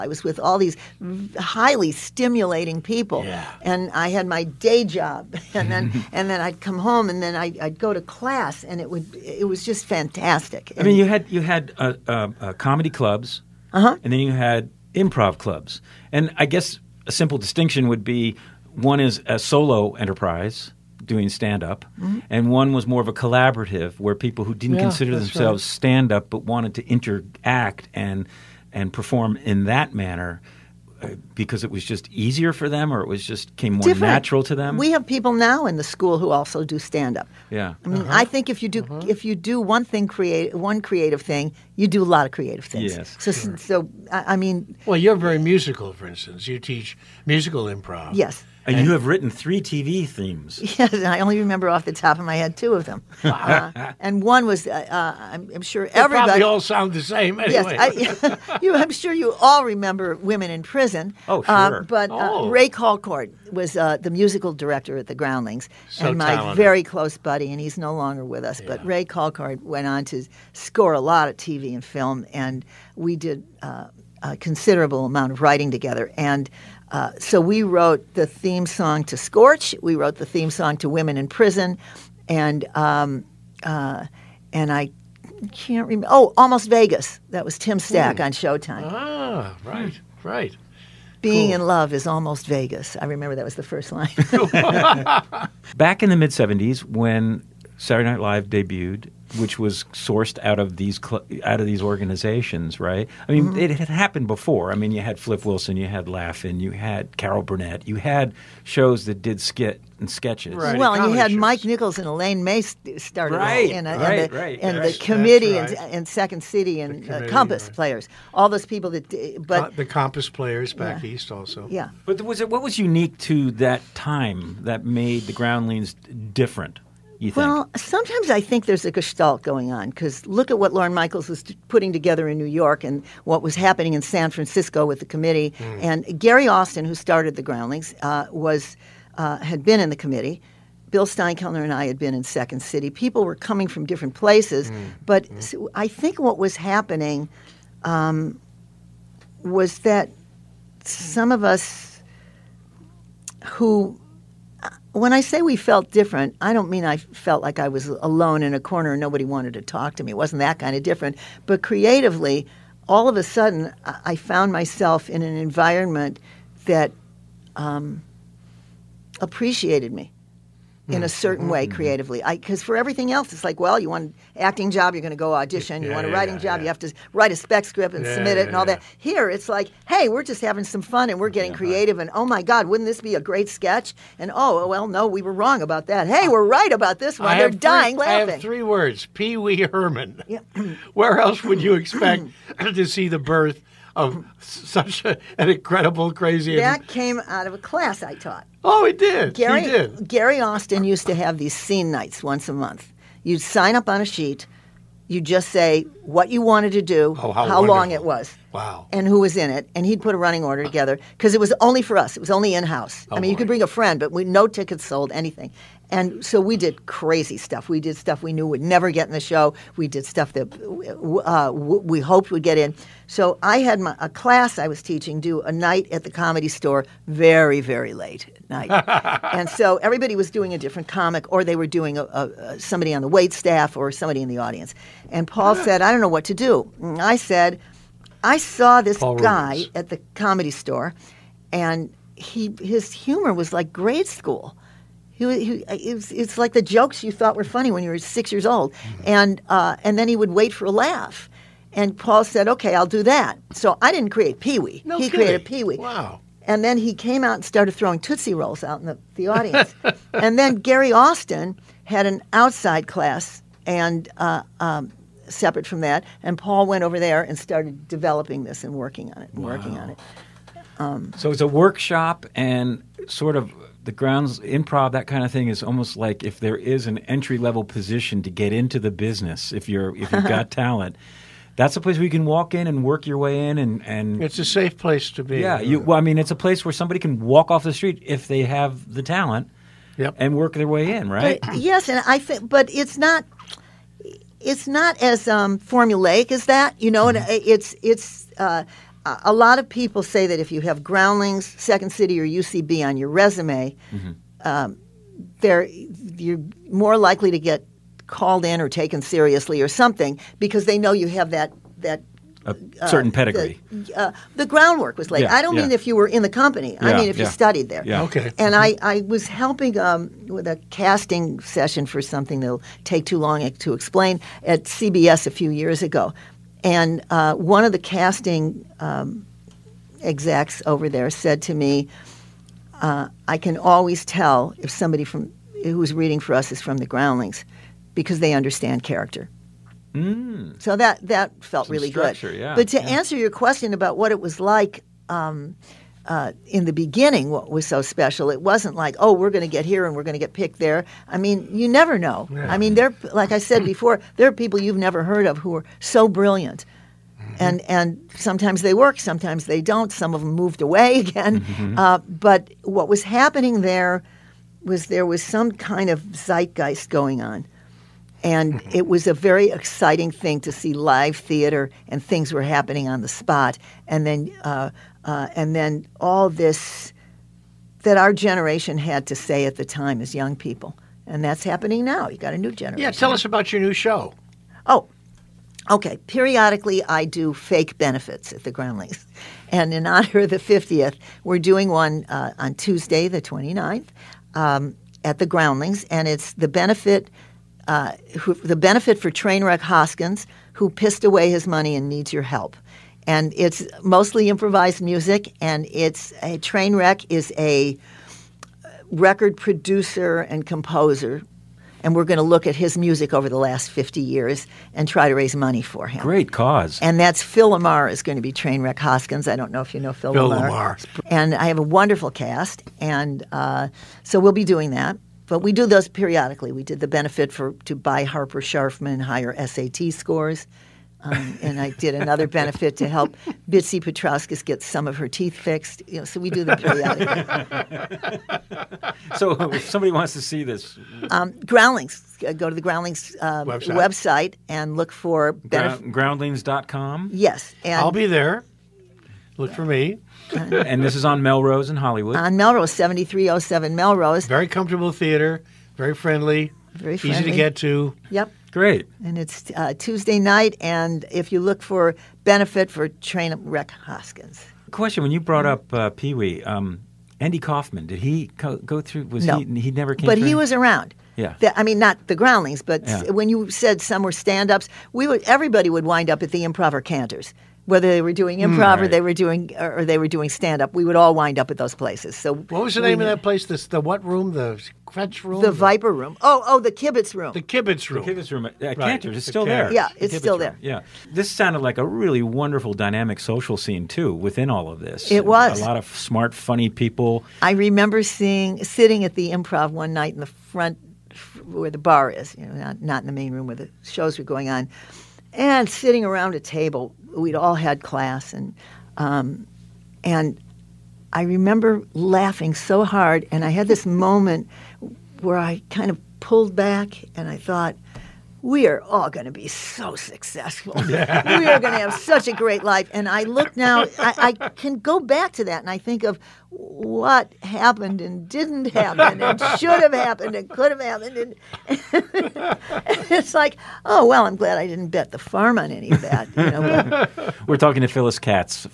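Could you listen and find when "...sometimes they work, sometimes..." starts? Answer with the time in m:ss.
5:58.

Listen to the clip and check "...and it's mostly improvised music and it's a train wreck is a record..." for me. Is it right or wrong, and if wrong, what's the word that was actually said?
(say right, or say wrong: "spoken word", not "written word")
right.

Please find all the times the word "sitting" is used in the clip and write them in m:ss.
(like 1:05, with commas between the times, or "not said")
8:18, 8:25.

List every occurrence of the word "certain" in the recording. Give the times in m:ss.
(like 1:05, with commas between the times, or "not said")
2:51, 5:12.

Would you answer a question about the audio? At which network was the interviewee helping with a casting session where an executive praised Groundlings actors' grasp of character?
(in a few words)
CBS.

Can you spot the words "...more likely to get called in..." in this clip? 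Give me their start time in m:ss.
5:06.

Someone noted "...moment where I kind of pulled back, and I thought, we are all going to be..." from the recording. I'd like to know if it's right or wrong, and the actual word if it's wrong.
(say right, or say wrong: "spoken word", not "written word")
right.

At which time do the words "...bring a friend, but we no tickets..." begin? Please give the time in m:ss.
3:33.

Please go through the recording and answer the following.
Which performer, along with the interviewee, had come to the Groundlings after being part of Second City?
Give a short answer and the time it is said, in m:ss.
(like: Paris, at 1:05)
Bill Steinkellner, at 2:20.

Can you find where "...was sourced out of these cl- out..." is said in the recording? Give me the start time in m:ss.
1:39.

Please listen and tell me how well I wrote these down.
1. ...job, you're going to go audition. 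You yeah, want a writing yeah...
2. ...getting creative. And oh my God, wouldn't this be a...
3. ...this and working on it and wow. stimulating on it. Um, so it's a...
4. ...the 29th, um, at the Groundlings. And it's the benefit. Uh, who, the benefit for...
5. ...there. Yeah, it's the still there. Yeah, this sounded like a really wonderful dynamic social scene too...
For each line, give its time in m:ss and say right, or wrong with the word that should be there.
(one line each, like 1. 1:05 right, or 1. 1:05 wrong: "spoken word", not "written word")
1. 2:54 right
2. 3:01 right
3. 4:28 wrong: "working", not "stimulating"
4. 6:33 right
5. 8:09 right.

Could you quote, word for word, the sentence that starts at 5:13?
The, uh, the, groundwork was laid.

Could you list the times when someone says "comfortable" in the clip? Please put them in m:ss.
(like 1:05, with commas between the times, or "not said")
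7:34.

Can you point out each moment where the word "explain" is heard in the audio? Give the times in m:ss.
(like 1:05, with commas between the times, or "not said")
5:23.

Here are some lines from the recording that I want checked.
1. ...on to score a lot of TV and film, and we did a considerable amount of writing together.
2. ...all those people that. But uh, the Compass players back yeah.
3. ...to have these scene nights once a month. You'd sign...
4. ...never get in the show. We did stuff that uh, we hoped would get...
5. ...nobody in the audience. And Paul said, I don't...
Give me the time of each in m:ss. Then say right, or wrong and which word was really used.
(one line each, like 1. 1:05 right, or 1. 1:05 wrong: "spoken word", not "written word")
1. 1:09 right
2. 1:58 right
3. 3:21 right
4. 3:38 right
5. 3:53 wrong: "somebody", not "nobody".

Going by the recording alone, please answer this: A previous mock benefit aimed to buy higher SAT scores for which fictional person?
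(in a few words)
Harper Sharfman.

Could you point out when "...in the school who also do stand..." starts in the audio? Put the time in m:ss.
0:35.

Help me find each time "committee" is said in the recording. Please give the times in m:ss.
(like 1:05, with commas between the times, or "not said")
1:54, 2:15, 2:19.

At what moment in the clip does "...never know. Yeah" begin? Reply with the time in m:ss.
5:51.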